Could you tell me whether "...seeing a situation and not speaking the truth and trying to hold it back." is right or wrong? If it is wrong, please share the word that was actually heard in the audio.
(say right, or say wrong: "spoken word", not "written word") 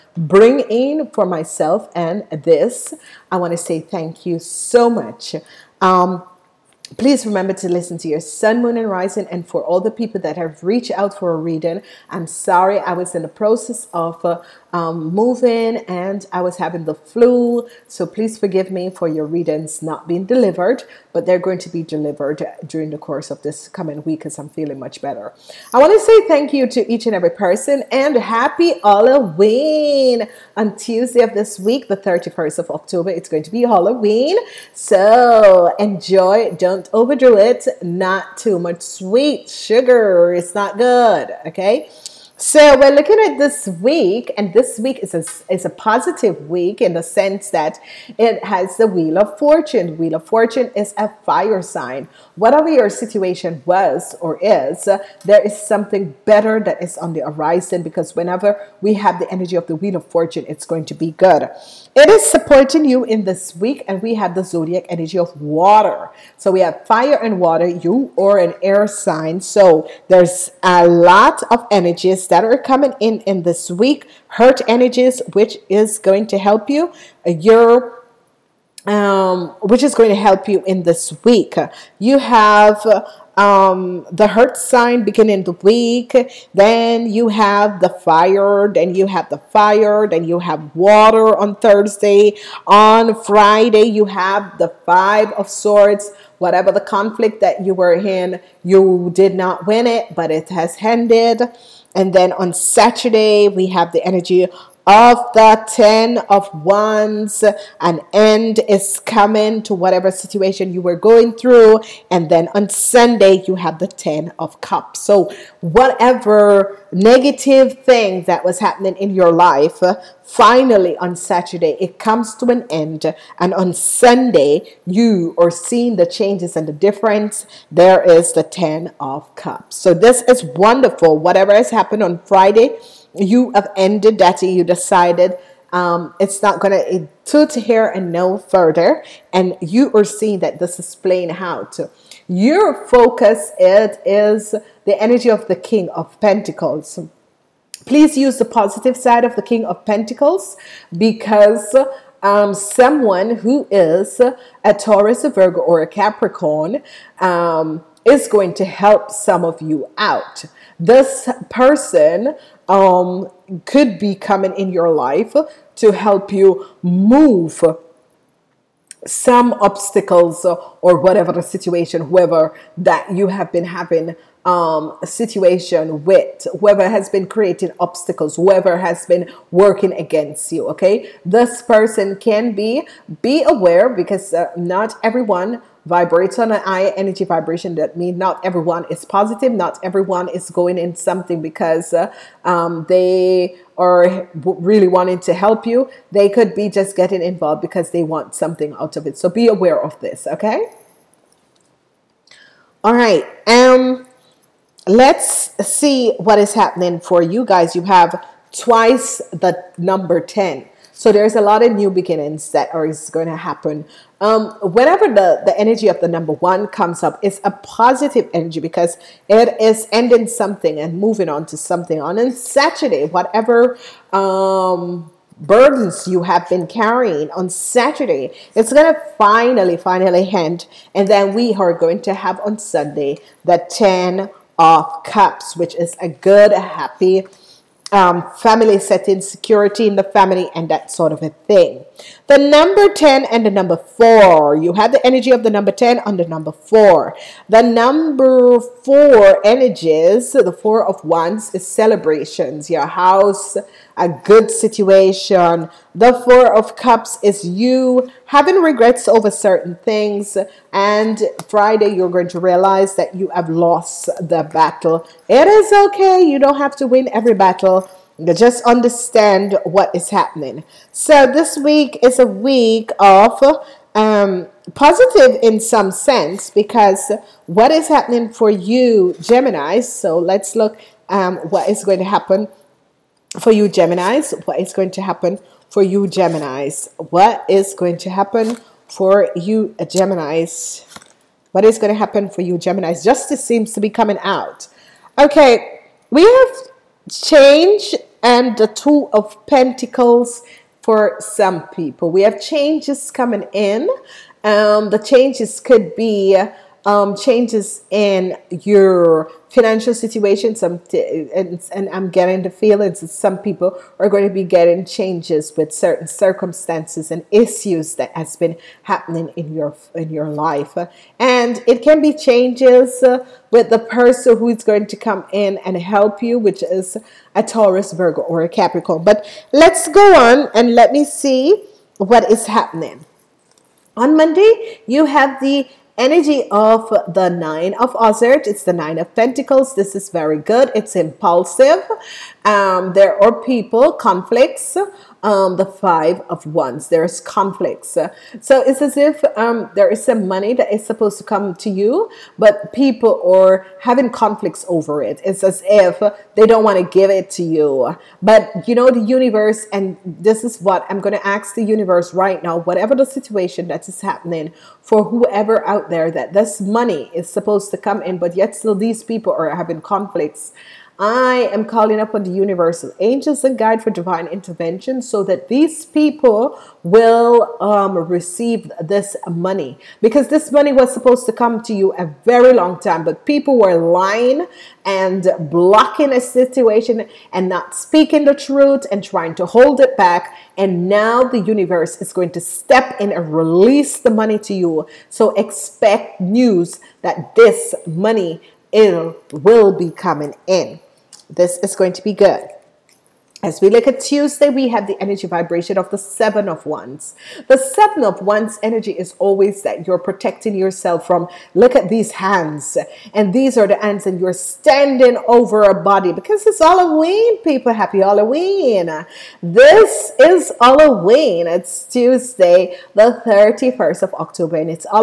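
wrong: "blocking", not "seeing".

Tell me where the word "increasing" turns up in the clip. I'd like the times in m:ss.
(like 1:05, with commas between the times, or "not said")
not said.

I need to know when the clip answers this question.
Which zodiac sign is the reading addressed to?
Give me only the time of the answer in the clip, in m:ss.
4:39.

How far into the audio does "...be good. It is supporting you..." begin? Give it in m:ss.
1:00.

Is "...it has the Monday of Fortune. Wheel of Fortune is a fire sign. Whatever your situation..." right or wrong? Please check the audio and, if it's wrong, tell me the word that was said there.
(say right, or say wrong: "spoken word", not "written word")
wrong: "Wheel", not "Monday".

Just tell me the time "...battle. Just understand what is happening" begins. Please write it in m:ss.
4:27.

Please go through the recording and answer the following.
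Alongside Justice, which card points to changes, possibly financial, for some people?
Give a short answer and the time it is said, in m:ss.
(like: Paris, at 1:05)
Two of Pentacles, at 4:58.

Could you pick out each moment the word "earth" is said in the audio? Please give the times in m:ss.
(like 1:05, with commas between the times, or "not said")
1:14, 1:24.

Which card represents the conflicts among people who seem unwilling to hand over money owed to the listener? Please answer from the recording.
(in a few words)
Five of Wands.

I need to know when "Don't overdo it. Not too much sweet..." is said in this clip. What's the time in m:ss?
0:36.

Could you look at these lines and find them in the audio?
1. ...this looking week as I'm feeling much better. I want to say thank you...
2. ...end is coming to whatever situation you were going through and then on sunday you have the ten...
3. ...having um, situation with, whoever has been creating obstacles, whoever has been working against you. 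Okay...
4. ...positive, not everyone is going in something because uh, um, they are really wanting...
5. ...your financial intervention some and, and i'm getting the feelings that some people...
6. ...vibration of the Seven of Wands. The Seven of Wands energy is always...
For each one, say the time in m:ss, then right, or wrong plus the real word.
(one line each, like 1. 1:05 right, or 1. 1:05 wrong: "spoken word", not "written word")
1. 0:23 wrong: "coming", not "looking"
2. 1:48 right
3. 2:53 right
4. 3:09 right
5. 5:08 wrong: "situation", not "intervention"
6. 6:45 right.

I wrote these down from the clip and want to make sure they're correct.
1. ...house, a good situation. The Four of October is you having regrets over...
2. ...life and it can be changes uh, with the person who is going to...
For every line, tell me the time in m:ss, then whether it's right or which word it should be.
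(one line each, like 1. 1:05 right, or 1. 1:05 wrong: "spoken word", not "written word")
1. 4:12 wrong: "Cups", not "October"
2. 5:20 right.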